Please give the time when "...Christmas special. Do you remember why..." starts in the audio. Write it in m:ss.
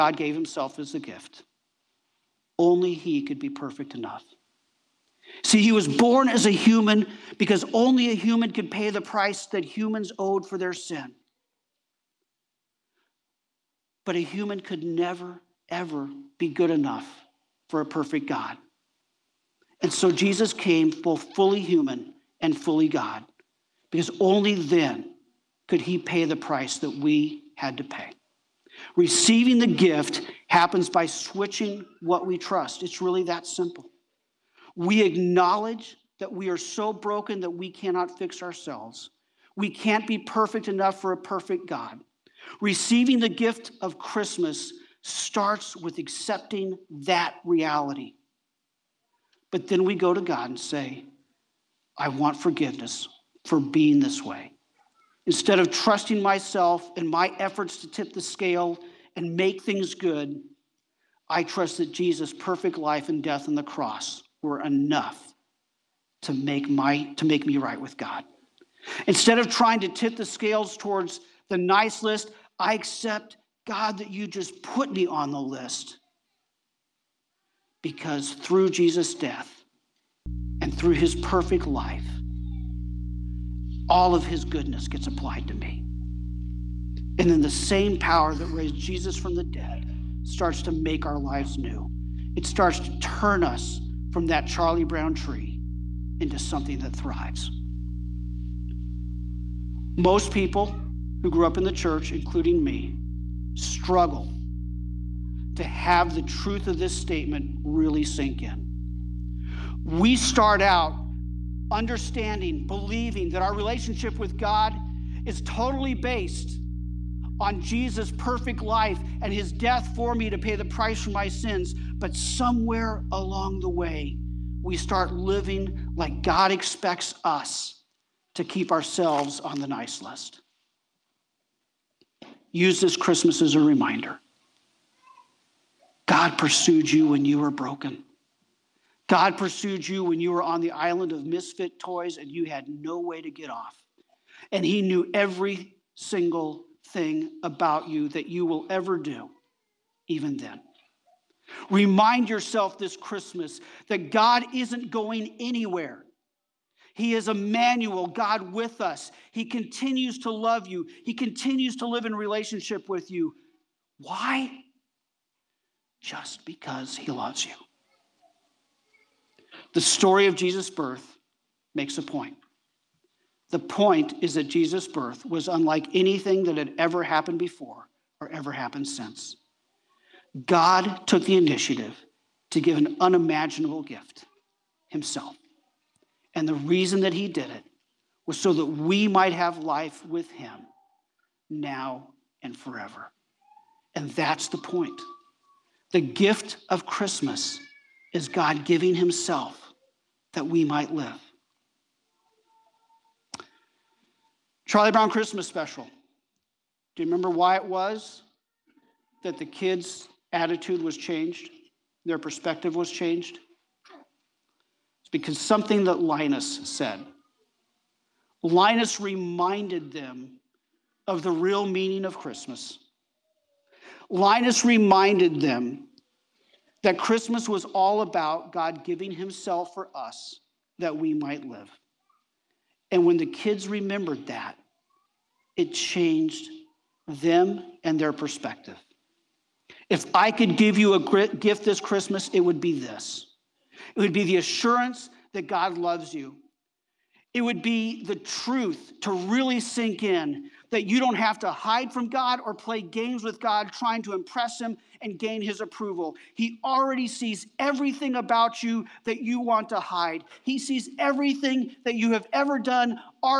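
3:25.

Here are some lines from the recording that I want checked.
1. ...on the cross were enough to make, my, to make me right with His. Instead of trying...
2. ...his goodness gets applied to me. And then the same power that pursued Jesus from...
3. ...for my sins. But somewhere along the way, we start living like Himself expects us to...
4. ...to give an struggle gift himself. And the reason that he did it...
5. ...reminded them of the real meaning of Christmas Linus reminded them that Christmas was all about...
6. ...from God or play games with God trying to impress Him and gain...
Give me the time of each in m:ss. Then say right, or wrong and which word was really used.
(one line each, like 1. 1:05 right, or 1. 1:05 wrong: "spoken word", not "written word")
1. 1:03 wrong: "God", not "His"
2. 1:24 wrong: "raised", not "pursued"
3. 2:01 wrong: "God", not "Himself"
4. 3:02 wrong: "unimaginable", not "struggle"
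5. 3:38 right
6. 4:11 right.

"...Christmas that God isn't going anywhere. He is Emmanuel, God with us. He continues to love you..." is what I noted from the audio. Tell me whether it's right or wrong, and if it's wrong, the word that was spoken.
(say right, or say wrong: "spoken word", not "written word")
right.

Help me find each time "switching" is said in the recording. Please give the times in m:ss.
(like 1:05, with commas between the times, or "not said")
0:31.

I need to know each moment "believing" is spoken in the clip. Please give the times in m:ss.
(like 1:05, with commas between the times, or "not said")
1:52.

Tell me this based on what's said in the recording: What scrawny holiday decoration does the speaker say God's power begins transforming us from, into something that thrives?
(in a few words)
Charlie Brown tree.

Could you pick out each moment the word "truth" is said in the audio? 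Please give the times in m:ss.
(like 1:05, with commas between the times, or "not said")
1:46, 4:08.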